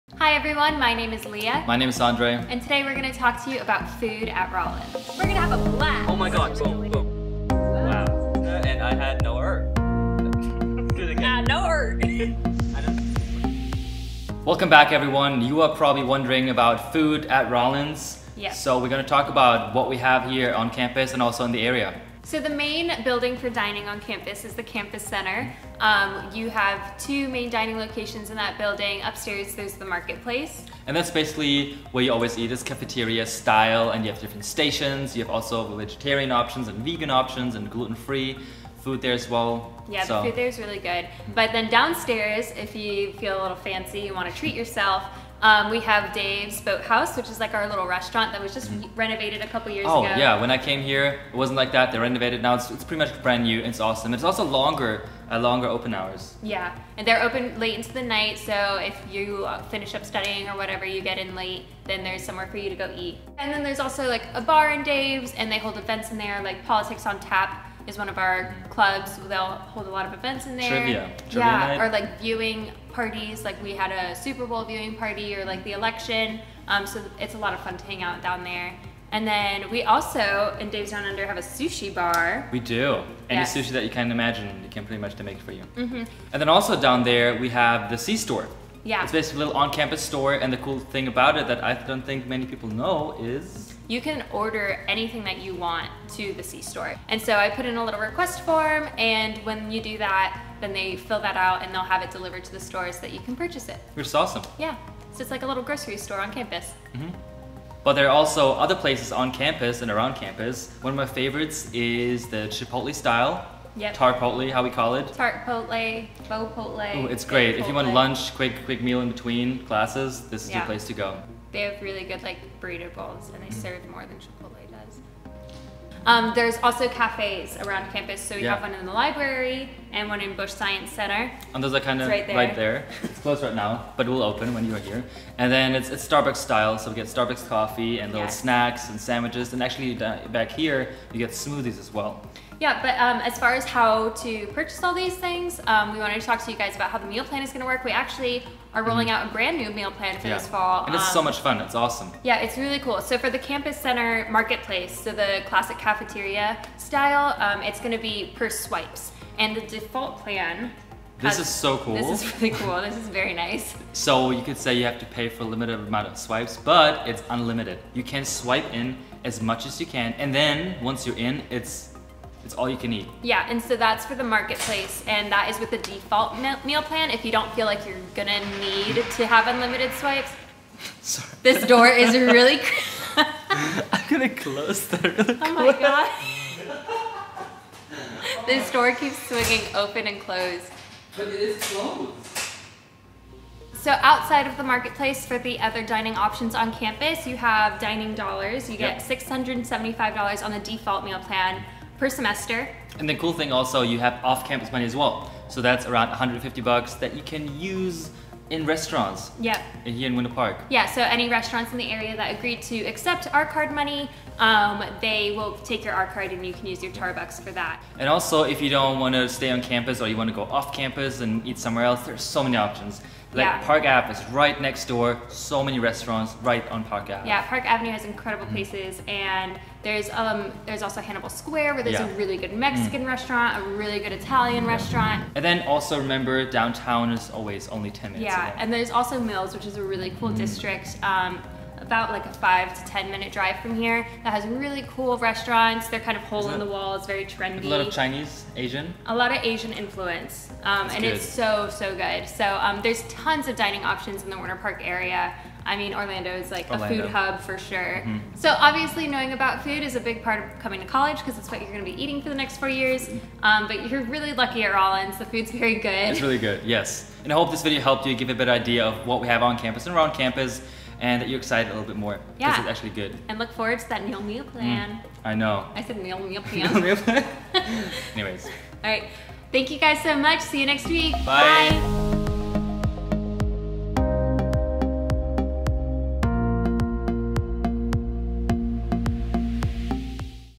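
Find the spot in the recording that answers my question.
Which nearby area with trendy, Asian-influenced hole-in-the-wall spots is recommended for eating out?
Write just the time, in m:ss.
3:59.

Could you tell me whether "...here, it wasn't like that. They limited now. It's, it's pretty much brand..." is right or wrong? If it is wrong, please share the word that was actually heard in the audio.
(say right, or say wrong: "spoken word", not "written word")
wrong: "renovated", not "limited".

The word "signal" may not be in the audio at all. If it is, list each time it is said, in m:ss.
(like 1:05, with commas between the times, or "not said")
not said.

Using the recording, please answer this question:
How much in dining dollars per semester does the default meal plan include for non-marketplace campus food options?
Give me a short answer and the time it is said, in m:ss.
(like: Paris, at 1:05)
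$675, at 3:19.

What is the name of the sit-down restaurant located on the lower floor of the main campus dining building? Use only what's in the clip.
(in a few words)
Dave's Boathouse.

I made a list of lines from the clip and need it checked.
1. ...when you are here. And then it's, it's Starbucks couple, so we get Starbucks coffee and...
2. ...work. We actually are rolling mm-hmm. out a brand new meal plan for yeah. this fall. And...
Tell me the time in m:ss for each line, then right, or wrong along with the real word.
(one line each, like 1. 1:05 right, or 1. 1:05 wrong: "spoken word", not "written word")
1. 2:14 wrong: "style", not "couple"
2. 2:27 right.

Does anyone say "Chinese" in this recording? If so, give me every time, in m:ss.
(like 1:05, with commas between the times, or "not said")
4:07.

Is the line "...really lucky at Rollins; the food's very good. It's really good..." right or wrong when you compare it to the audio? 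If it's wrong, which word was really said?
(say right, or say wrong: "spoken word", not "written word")
right.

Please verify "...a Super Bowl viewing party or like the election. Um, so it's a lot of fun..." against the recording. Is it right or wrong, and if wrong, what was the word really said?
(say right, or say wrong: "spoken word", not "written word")
right.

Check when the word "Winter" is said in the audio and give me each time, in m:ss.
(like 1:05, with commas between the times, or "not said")
3:30, 4:14.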